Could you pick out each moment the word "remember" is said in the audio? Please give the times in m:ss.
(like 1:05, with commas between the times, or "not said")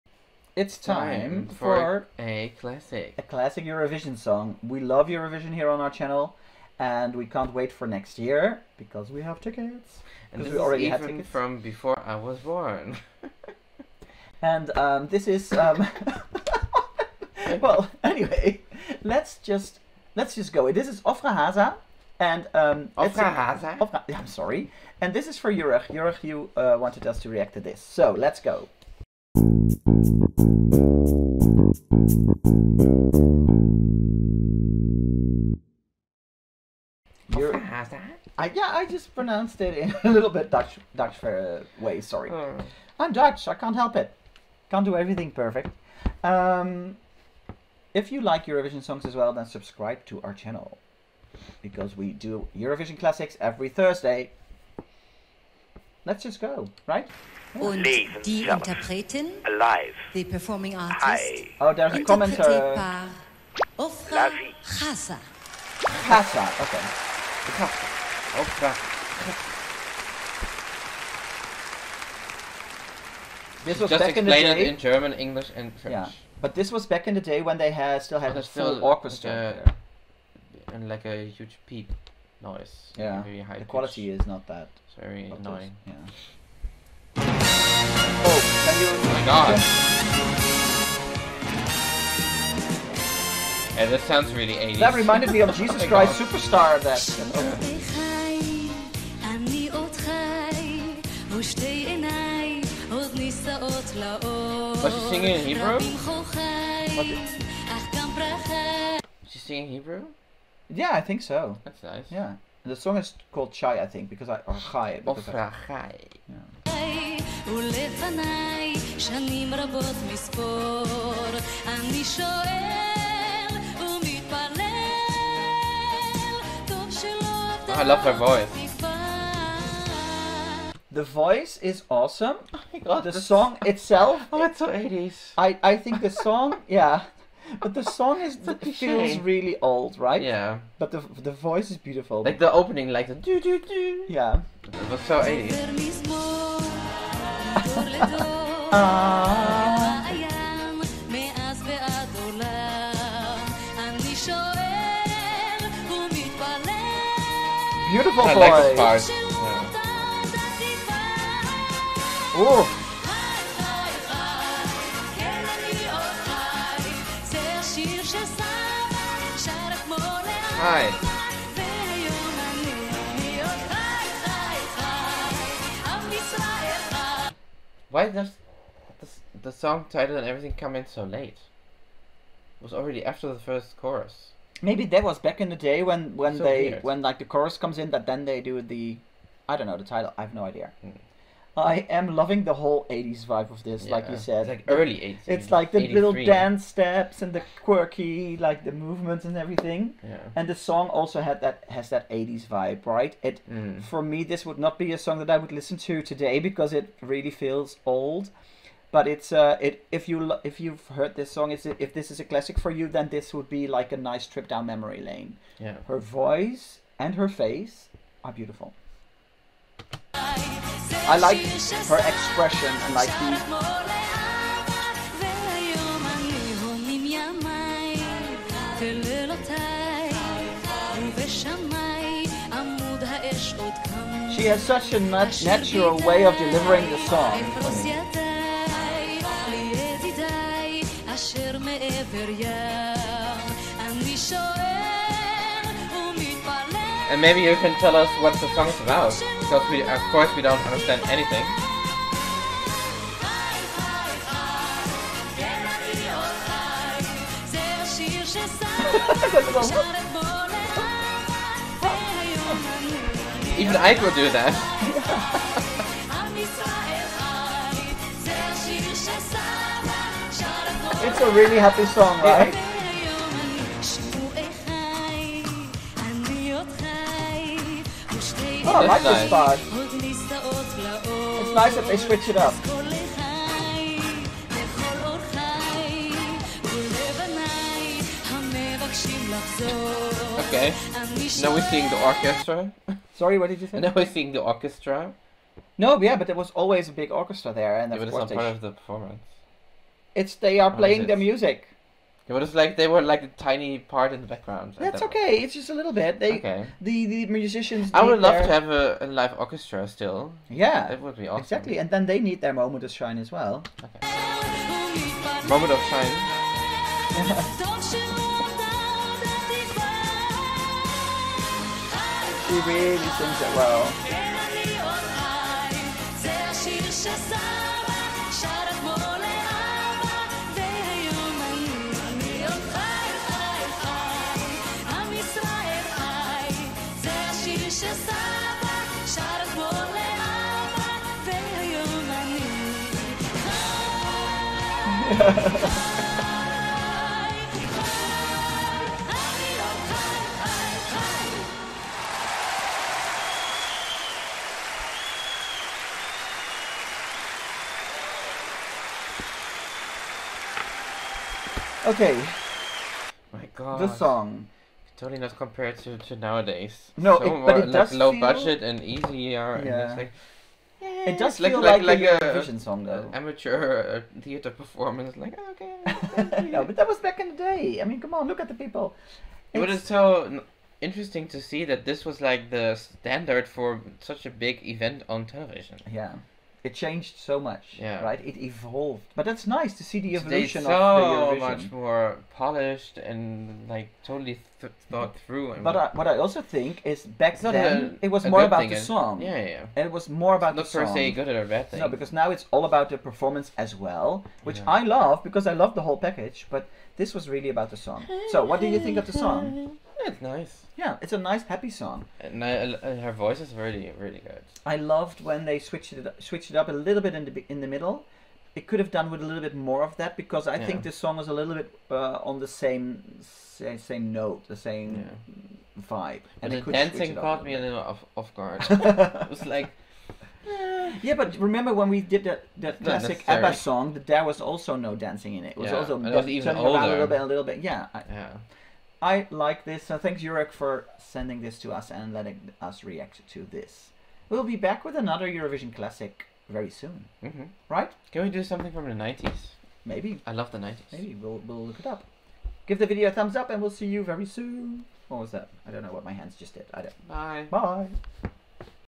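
7:11.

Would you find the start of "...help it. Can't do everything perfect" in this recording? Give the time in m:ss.
0:43.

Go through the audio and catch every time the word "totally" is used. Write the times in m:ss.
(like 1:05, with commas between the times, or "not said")
6:04, 6:34.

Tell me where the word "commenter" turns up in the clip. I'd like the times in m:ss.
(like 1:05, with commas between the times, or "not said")
1:02.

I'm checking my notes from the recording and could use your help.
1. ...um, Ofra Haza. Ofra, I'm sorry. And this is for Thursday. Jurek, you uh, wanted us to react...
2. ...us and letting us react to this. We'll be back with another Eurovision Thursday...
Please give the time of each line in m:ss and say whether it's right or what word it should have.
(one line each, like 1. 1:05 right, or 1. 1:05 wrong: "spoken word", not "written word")
1. 0:22 wrong: "Jurek", not "Thursday"
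2. 7:21 wrong: "Classic", not "Thursday".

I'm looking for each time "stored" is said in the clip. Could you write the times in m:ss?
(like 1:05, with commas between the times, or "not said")
not said.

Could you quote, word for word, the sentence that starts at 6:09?
And it's like, it does like, feel like, like, like a Eurovision song though.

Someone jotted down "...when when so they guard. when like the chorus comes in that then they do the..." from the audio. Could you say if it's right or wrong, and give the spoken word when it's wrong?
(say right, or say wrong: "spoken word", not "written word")
wrong: "weird", not "guard".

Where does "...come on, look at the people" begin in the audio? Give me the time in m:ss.
6:17.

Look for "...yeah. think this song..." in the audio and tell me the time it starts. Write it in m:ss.
7:00.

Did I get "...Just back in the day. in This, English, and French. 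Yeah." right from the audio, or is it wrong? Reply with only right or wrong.
wrong.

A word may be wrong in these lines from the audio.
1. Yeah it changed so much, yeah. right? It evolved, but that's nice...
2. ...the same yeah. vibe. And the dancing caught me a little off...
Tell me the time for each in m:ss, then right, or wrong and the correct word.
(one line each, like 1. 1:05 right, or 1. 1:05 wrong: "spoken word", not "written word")
1. 6:25 right
2. 7:04 right.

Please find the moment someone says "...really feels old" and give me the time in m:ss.
3:27.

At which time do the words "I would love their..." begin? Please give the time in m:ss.
5:07.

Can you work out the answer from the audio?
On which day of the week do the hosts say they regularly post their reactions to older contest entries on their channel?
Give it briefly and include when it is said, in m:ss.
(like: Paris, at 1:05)
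Thursday, at 0:53.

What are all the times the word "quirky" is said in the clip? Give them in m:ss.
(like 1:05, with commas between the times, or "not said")
3:17.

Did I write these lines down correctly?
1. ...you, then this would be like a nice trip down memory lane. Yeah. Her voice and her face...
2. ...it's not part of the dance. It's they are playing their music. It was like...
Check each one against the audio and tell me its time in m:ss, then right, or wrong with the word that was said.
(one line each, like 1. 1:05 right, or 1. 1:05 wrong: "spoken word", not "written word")
1. 3:32 right
2. 4:58 wrong: "performance", not "dance".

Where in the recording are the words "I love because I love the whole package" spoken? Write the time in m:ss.
6:44.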